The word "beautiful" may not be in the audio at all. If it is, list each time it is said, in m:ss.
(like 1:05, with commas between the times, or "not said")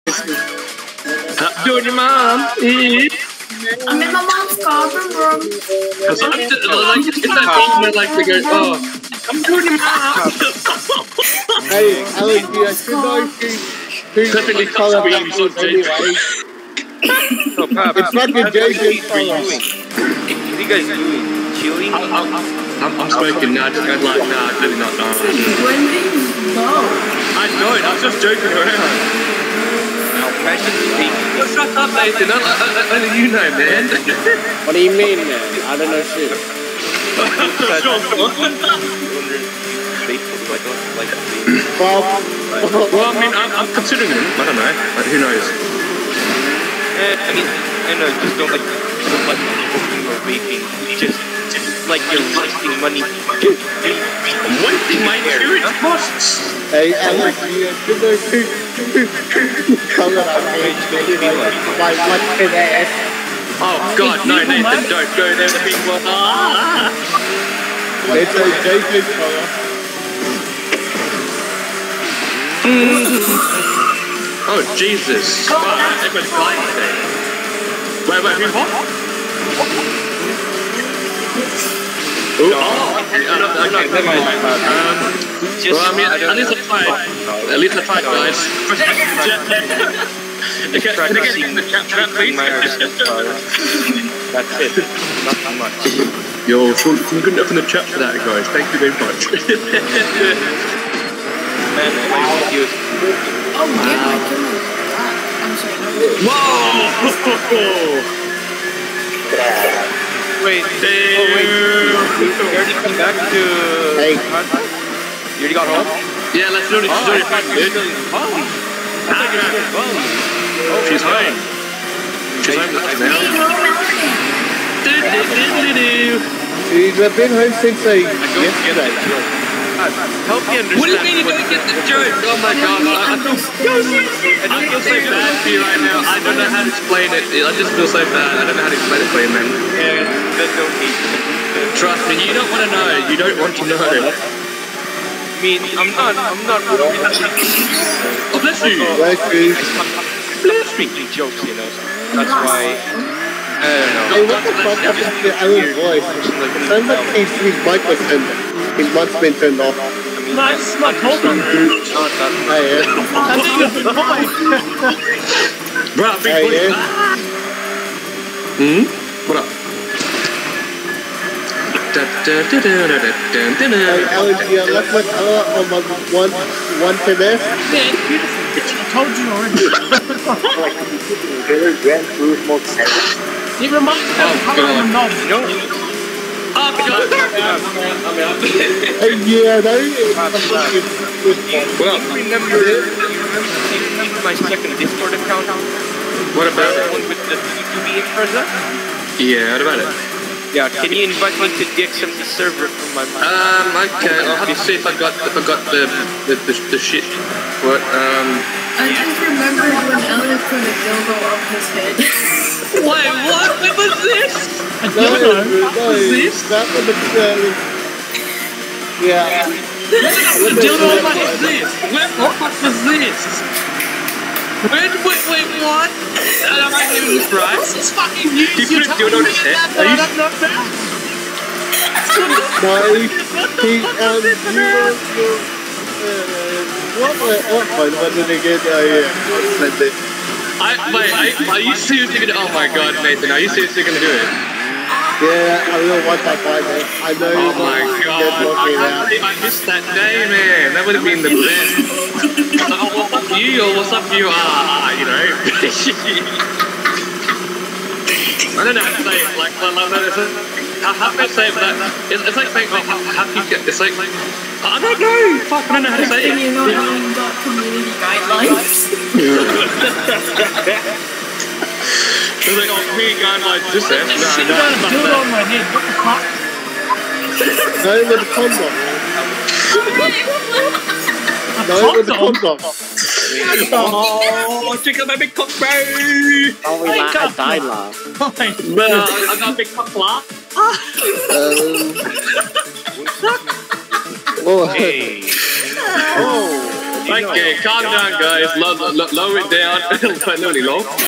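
2:58.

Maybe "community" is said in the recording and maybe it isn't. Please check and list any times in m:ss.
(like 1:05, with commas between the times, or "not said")
4:27, 4:32.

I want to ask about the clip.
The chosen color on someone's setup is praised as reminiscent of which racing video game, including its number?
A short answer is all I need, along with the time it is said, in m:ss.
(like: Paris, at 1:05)
Gran Turismo 7, at 3:01.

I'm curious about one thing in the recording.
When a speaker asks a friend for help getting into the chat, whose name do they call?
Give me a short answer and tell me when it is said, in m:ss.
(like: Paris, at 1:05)
Sean, at 1:36.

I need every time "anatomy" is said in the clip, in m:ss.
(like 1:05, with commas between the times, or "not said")
not said.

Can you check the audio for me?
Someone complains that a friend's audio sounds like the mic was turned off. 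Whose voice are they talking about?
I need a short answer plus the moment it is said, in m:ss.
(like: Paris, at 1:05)
Alan, at 2:35.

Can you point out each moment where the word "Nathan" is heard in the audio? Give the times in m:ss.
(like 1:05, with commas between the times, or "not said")
0:31, 4:03.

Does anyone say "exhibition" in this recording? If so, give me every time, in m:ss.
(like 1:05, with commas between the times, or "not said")
not said.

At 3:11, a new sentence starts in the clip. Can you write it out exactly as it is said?
Well, you remember, my second Discord account?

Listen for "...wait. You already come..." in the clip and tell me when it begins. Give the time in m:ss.
1:51.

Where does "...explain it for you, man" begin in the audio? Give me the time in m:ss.
2:18.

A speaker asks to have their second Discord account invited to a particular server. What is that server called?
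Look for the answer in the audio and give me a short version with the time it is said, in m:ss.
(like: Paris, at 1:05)
XMT, at 3:21.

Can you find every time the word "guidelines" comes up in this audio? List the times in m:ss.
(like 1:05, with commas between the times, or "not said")
4:28, 4:33.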